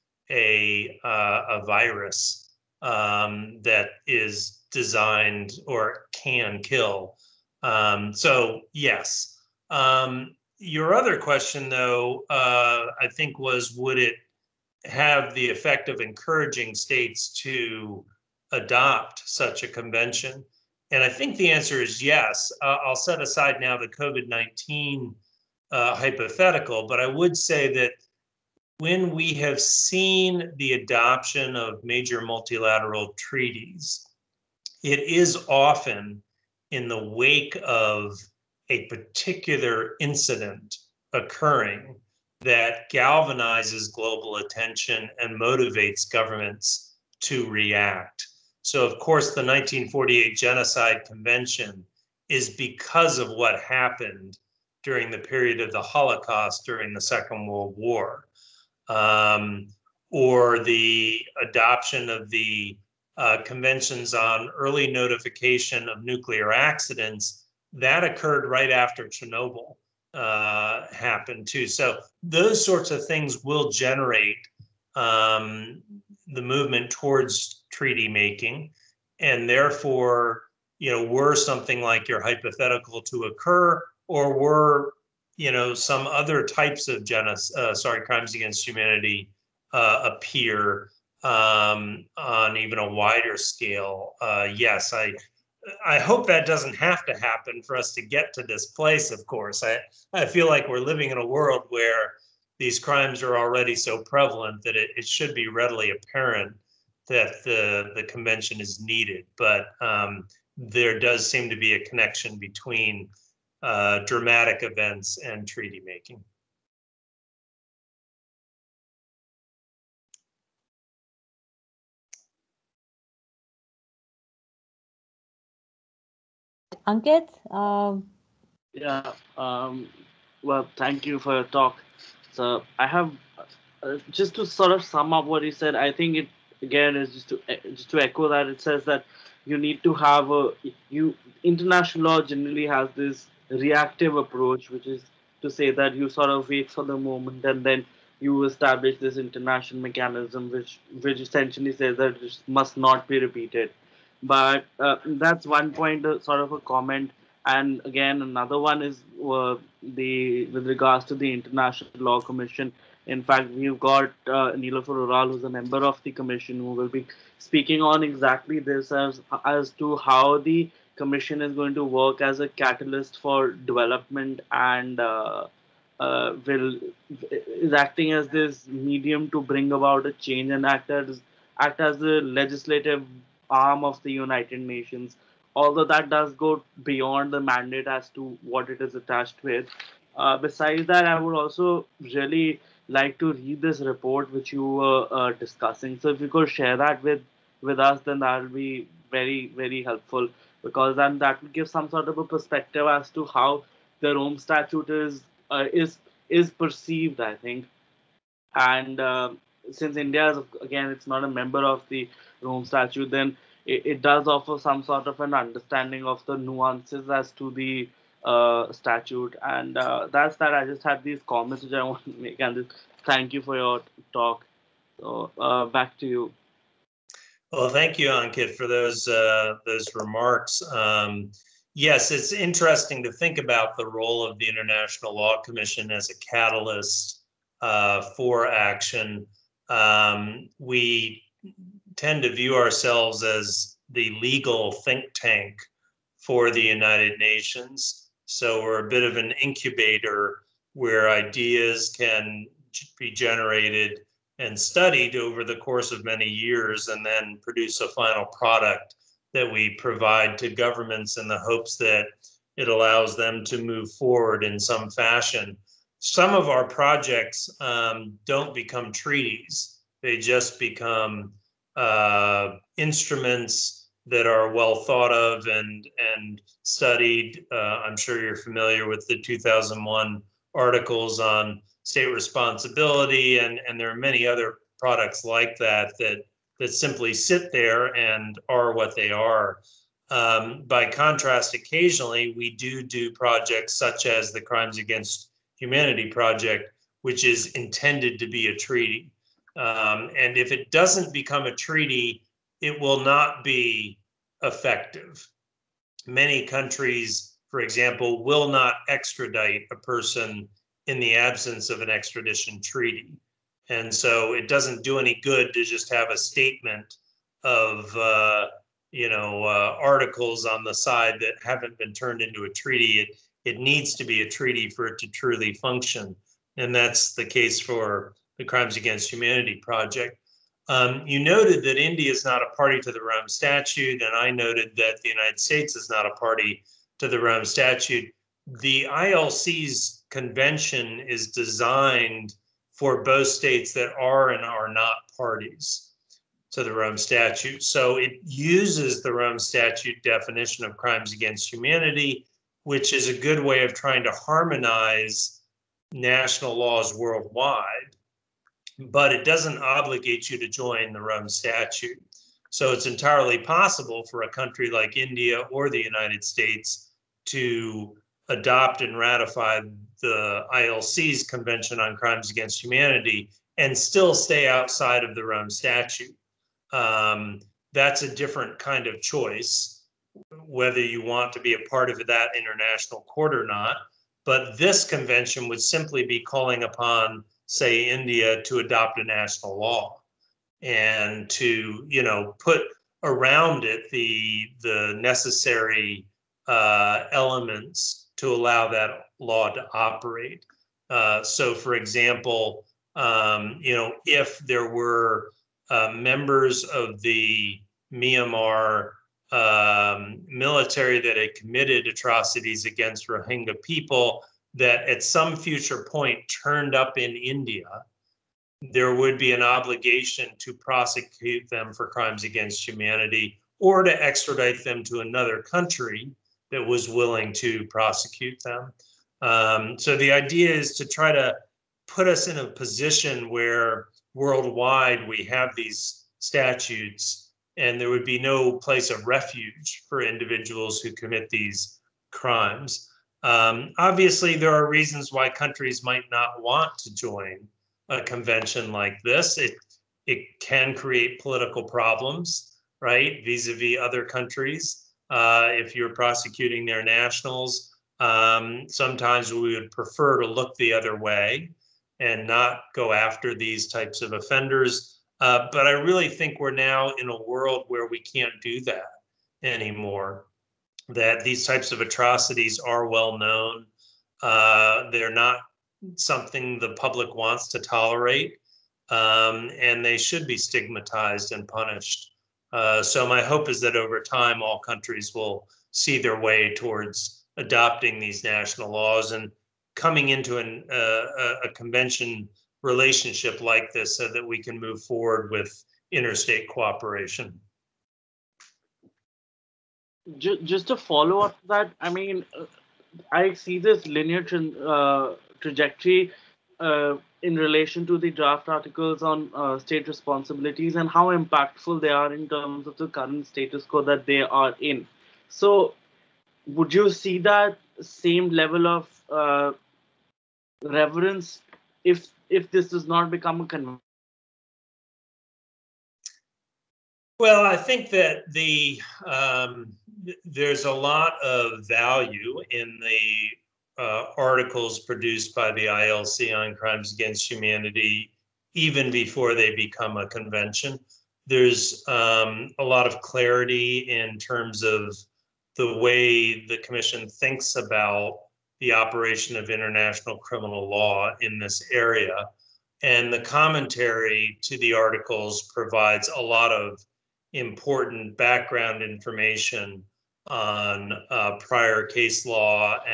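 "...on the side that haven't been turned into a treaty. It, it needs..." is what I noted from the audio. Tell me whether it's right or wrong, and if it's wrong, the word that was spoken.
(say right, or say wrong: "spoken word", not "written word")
right.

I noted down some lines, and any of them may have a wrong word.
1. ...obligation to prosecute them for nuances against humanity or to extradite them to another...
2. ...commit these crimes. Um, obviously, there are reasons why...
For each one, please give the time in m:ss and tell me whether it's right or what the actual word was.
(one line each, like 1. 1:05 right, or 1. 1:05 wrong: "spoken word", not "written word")
1. 6:59 wrong: "crimes", not "nuances"
2. 7:20 right.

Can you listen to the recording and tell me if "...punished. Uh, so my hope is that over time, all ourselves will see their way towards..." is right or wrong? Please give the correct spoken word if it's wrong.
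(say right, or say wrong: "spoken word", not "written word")
wrong: "countries", not "ourselves".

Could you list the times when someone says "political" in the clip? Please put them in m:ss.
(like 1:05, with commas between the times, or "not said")
7:31.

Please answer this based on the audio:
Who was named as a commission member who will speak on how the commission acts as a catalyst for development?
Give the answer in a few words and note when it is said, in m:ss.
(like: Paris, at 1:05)
Nilüfer Oral, at 2:44.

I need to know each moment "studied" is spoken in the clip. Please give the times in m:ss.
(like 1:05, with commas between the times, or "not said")
4:14, 4:36.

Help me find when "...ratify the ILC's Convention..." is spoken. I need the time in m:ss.
6:08.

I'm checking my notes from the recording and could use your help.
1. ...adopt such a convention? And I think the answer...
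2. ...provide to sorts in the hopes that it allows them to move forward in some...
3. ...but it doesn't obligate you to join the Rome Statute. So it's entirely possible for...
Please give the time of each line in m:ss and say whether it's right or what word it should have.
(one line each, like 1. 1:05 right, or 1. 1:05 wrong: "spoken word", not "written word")
1. 0:18 right
2. 4:19 wrong: "governments", not "sorts"
3. 5:58 right.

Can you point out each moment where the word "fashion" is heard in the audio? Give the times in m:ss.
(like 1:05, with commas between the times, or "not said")
4:24.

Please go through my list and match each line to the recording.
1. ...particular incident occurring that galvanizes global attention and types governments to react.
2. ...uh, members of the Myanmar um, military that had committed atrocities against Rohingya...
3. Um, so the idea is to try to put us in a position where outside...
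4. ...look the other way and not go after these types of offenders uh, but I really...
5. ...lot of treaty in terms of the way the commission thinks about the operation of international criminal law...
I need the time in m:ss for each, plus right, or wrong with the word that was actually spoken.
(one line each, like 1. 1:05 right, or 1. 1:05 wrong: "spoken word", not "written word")
1. 0:38 wrong: "motivates", not "types"
2. 6:45 right
3. 7:09 wrong: "worldwide", not "outside"
4. 7:40 right
5. 9:02 wrong: "clarity", not "treaty".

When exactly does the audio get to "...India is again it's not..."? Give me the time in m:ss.
3:29.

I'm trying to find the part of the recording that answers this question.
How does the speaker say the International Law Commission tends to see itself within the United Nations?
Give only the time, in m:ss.
4:04.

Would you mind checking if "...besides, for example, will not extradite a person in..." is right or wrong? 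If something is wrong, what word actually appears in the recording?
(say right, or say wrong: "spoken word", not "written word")
wrong: "countries", not "besides".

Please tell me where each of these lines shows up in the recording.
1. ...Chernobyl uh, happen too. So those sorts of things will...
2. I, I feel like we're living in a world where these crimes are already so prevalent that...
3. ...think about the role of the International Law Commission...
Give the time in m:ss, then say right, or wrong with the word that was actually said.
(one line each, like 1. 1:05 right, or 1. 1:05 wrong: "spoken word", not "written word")
1. 1:09 right
2. 1:39 right
3. 3:53 right.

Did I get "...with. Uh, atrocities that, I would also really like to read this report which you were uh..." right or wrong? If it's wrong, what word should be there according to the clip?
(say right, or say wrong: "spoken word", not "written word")
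wrong: "besides", not "atrocities".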